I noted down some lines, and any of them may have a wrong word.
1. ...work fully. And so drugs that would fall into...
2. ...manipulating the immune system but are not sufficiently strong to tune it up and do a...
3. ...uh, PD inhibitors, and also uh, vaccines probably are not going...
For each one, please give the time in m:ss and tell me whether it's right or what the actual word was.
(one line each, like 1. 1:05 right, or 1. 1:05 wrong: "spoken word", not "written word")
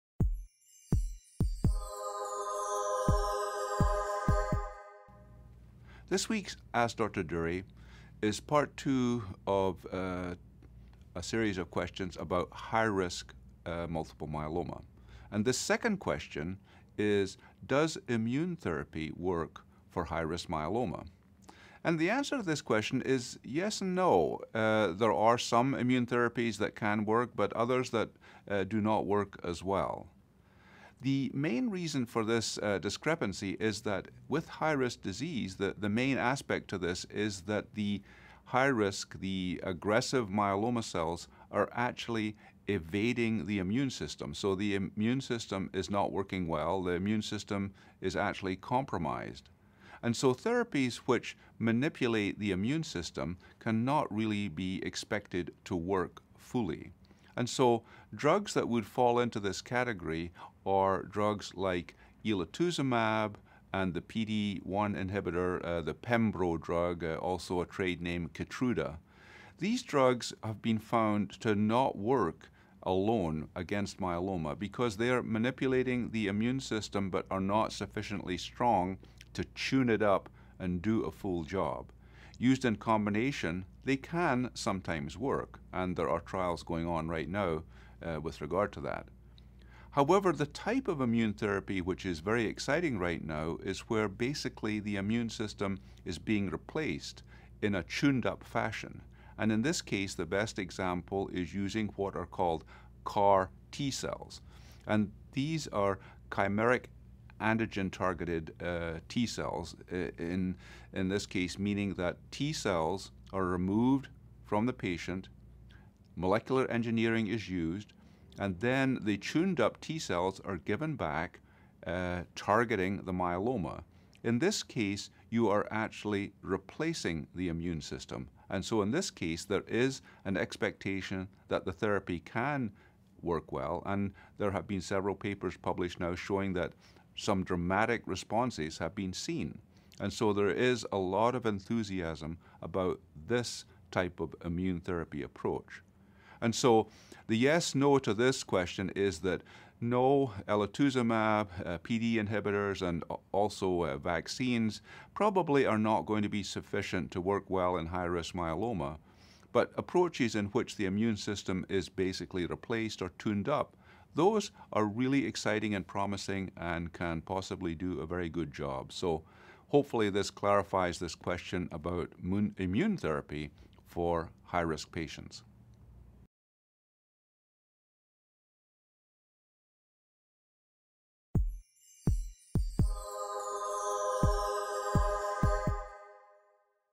1. 0:55 right
2. 1:15 right
3. 2:31 right.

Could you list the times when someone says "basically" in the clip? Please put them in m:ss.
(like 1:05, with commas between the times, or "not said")
1:34, 2:41.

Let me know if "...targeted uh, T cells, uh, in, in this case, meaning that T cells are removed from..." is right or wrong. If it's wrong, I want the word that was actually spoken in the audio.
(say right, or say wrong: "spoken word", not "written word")
right.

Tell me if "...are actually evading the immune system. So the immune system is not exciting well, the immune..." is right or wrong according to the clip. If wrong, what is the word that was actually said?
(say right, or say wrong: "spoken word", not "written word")
wrong: "working", not "exciting".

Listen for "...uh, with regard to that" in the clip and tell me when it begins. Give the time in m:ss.
1:28.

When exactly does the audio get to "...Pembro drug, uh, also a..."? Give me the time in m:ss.
1:05.